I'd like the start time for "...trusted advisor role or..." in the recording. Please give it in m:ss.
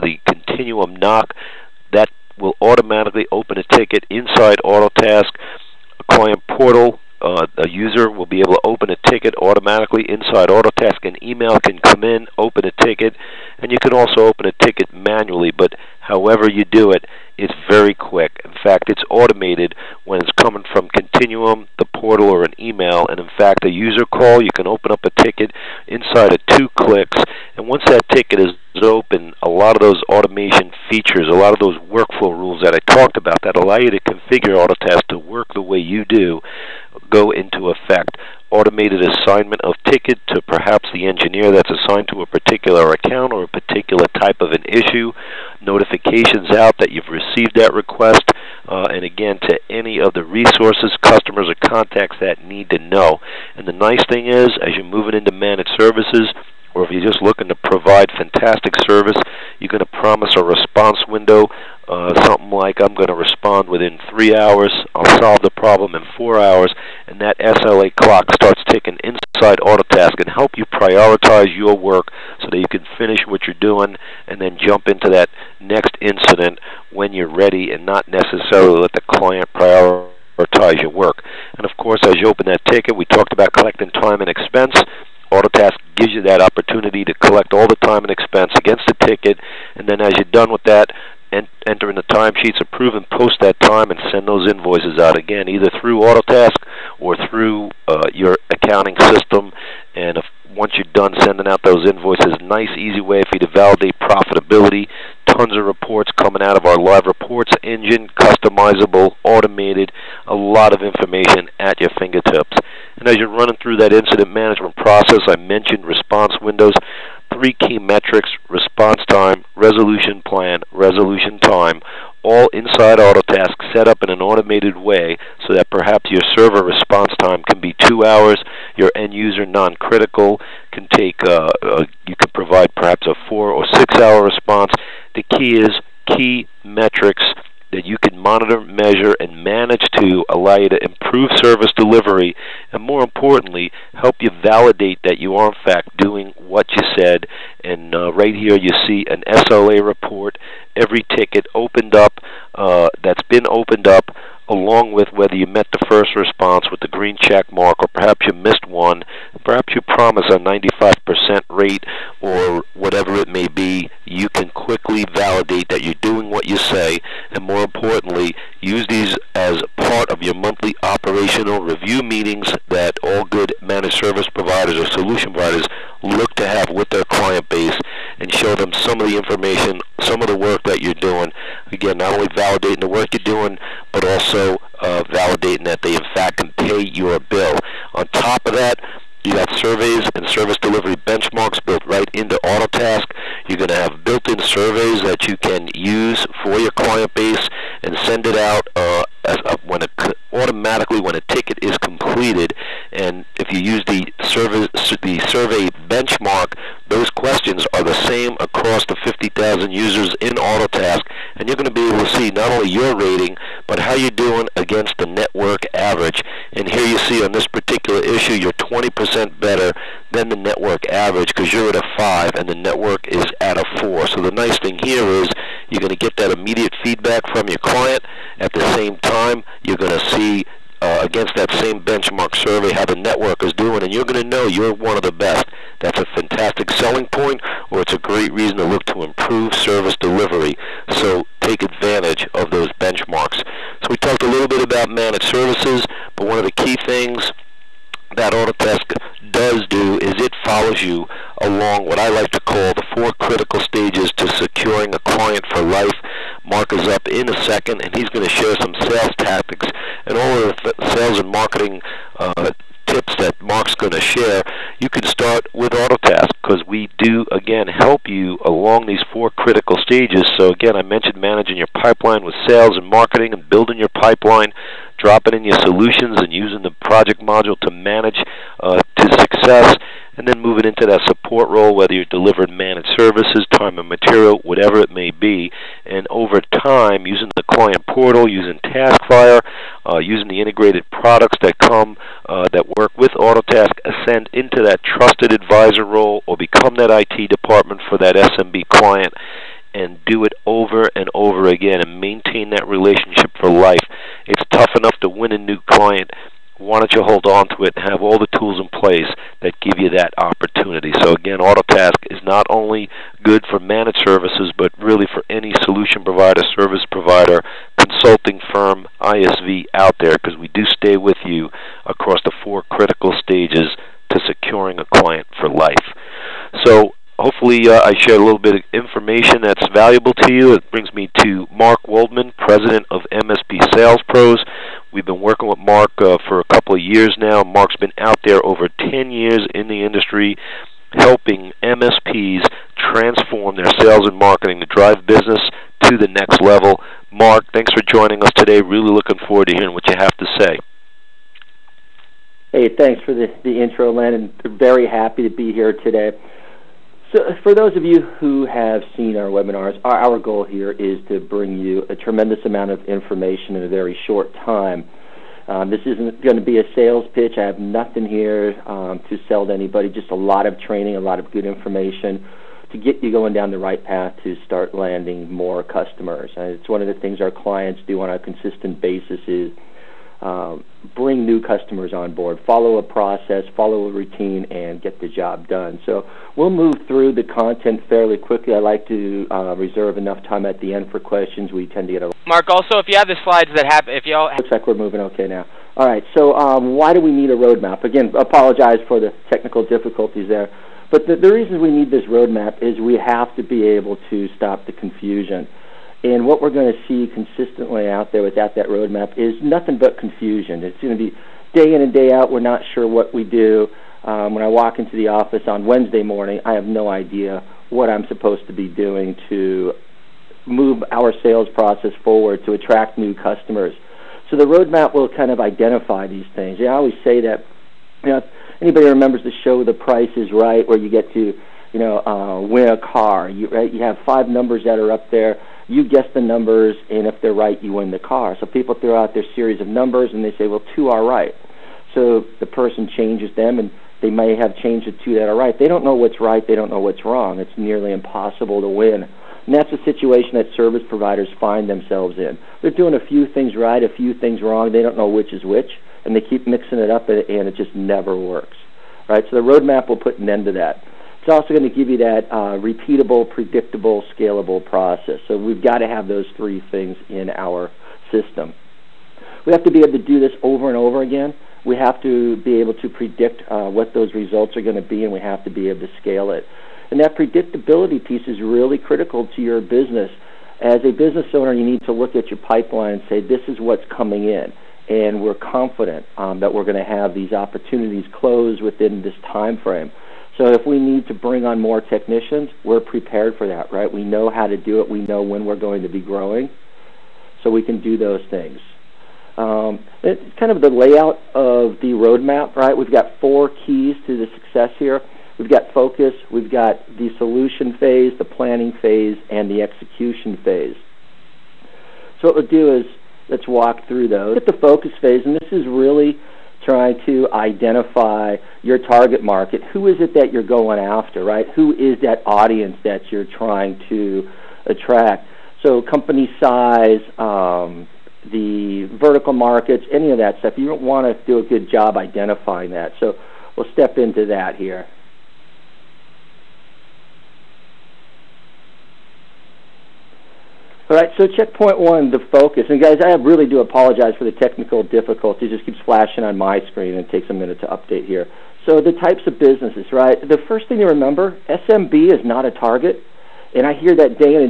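4:54.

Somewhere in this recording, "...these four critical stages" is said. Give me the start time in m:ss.
4:28.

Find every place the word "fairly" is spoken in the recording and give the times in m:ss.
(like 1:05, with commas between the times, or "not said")
6:27.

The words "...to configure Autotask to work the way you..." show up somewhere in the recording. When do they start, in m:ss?
0:33.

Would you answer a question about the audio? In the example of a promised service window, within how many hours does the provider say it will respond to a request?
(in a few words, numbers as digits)
3.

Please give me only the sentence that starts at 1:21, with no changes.
And of course, as you open that ticket, we talked about collecting time and expense.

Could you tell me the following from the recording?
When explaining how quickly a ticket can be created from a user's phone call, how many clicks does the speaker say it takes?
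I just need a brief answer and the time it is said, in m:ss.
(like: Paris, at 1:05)
2, at 0:26.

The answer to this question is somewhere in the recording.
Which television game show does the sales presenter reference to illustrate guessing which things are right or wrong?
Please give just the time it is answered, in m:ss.
7:09.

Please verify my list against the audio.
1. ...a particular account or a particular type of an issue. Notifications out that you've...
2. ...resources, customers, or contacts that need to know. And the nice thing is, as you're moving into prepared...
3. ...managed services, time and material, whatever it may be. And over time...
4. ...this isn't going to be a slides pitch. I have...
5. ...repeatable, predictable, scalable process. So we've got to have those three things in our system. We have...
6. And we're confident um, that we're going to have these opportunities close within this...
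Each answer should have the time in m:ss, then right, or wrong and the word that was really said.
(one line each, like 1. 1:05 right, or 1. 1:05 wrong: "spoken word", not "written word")
1. 0:42 right
2. 0:50 wrong: "managed", not "prepared"
3. 4:42 right
4. 6:05 wrong: "sales", not "slides"
5. 7:42 right
6. 8:04 right.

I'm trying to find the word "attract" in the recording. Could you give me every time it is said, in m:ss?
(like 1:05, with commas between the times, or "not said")
7:02, 8:44.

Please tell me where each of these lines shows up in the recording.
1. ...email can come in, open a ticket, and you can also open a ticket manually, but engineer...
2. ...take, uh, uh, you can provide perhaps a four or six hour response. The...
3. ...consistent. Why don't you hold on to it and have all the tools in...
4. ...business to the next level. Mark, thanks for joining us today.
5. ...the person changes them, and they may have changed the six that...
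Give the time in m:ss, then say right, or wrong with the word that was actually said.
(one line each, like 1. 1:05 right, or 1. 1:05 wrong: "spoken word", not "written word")
1. 0:11 wrong: "however", not "engineer"
2. 2:10 right
3. 5:05 wrong: "client", not "consistent"
4. 5:45 right
5. 7:22 wrong: "two", not "six".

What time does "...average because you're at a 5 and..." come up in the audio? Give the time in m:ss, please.
3:40.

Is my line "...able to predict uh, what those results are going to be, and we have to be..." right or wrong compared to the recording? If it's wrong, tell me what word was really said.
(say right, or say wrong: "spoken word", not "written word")
right.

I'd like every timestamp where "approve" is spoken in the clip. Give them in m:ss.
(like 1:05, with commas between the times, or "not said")
1:32.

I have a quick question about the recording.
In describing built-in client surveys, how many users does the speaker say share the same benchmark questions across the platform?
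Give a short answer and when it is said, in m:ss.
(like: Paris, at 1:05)
50,000, at 3:29.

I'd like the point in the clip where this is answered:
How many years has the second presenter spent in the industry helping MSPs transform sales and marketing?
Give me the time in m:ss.
5:38.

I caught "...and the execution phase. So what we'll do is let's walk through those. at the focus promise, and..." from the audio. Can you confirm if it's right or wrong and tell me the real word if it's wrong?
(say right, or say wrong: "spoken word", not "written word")
wrong: "phase", not "promise".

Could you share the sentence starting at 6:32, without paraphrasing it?
Also, if you have the slides that happen, if y'all looks like we're moving okay now.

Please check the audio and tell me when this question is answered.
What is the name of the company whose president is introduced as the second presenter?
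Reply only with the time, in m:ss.
5:33.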